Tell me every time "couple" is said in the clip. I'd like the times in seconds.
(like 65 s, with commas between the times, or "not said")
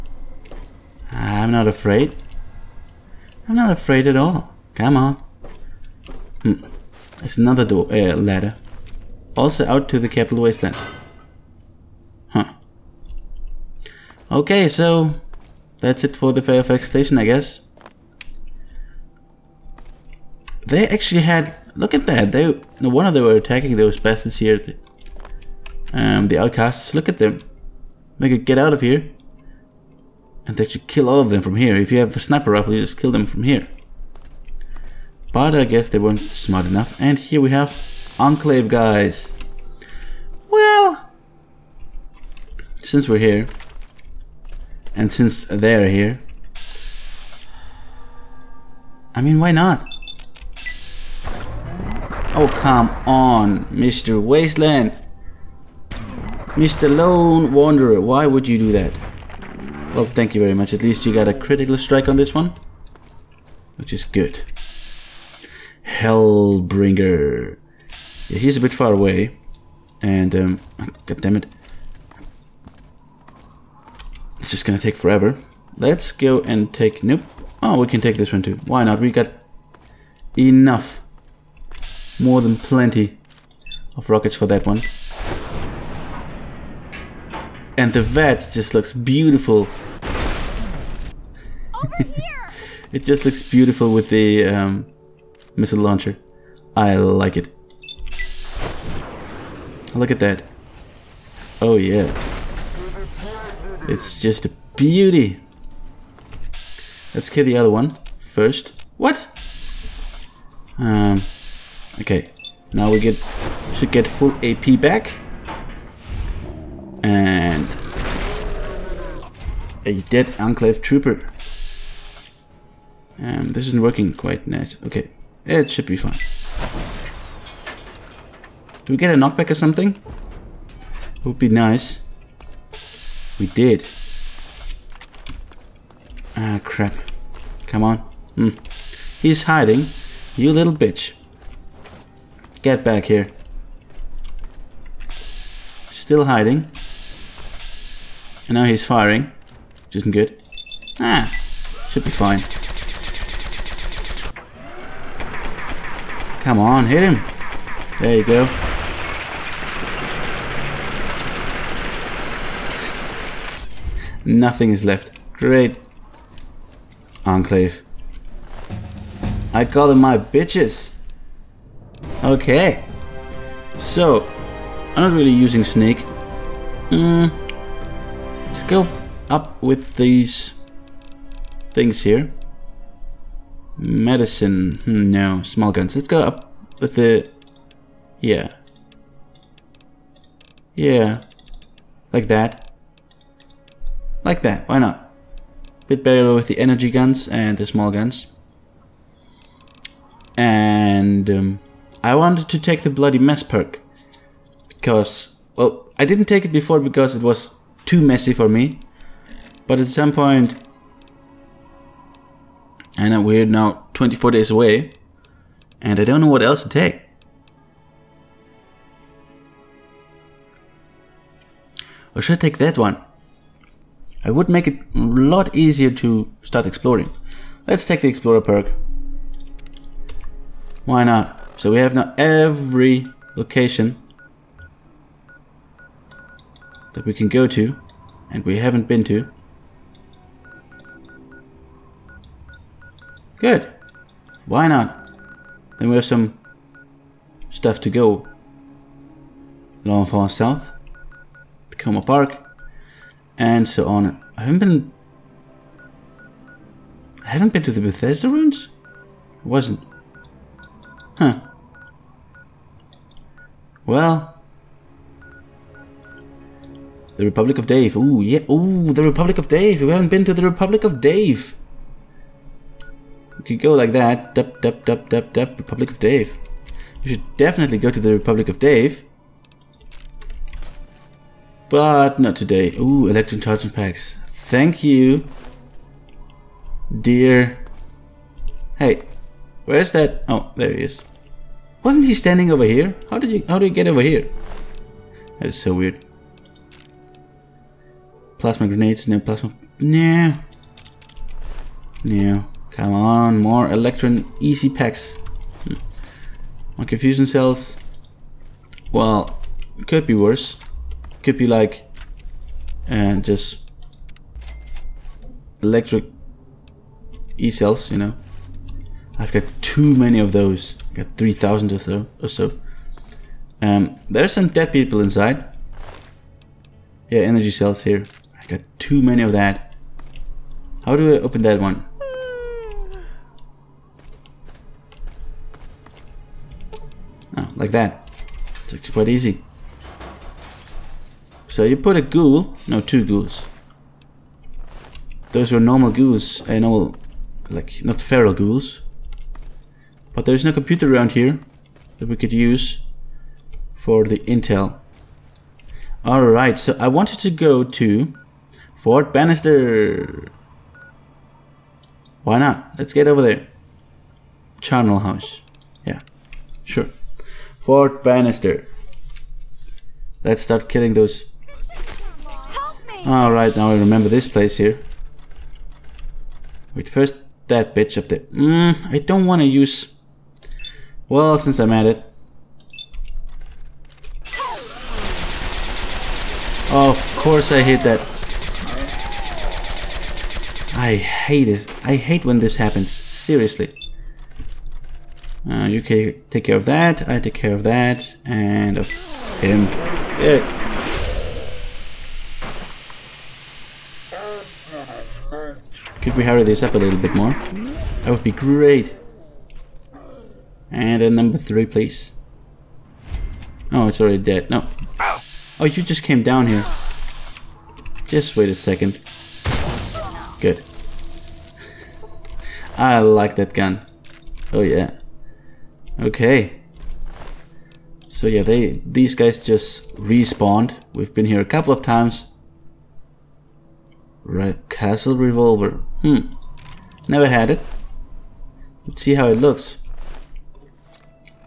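431 s.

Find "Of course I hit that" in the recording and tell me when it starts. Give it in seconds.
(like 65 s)
386 s.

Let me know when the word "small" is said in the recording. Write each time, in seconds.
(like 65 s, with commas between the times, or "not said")
185 s, 197 s.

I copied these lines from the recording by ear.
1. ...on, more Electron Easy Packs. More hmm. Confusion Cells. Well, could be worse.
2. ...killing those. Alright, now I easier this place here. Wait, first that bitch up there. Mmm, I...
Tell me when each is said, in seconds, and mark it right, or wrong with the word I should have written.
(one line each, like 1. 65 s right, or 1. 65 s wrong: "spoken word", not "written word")
1. 302 s right
2. 370 s wrong: "remember", not "easier".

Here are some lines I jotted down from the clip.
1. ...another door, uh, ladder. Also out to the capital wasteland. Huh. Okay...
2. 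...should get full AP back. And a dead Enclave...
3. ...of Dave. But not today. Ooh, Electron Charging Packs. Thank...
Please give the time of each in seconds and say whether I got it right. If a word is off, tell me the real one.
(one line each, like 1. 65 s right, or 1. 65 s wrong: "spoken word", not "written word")
1. 7 s right
2. 113 s right
3. 278 s right.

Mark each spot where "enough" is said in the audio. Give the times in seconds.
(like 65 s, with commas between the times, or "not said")
36 s, 80 s.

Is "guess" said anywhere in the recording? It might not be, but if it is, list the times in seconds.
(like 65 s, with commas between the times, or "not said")
17 s, 35 s.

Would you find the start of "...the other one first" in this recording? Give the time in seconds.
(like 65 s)
107 s.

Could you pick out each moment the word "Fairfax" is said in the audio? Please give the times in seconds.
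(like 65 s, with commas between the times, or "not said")
16 s.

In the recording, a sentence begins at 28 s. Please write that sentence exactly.
We could get out of here and they should kill all of them from here.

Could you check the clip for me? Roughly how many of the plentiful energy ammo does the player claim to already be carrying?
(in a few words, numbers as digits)
3,000.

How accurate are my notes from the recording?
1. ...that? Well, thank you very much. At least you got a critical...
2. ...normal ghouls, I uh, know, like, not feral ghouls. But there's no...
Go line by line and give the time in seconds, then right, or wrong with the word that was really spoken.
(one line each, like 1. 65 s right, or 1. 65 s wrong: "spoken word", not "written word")
1. 58 s right
2. 345 s right.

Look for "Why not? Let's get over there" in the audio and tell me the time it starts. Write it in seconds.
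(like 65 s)
362 s.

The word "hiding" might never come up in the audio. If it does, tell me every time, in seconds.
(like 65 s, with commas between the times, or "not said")
139 s, 146 s.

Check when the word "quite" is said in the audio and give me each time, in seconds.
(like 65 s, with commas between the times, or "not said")
124 s, 338 s.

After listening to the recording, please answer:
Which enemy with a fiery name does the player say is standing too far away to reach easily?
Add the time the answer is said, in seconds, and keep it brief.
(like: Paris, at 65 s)
Hellbringer, at 65 s.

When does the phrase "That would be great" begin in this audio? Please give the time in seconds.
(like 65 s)
408 s.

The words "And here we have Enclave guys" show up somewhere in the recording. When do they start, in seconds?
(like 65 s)
36 s.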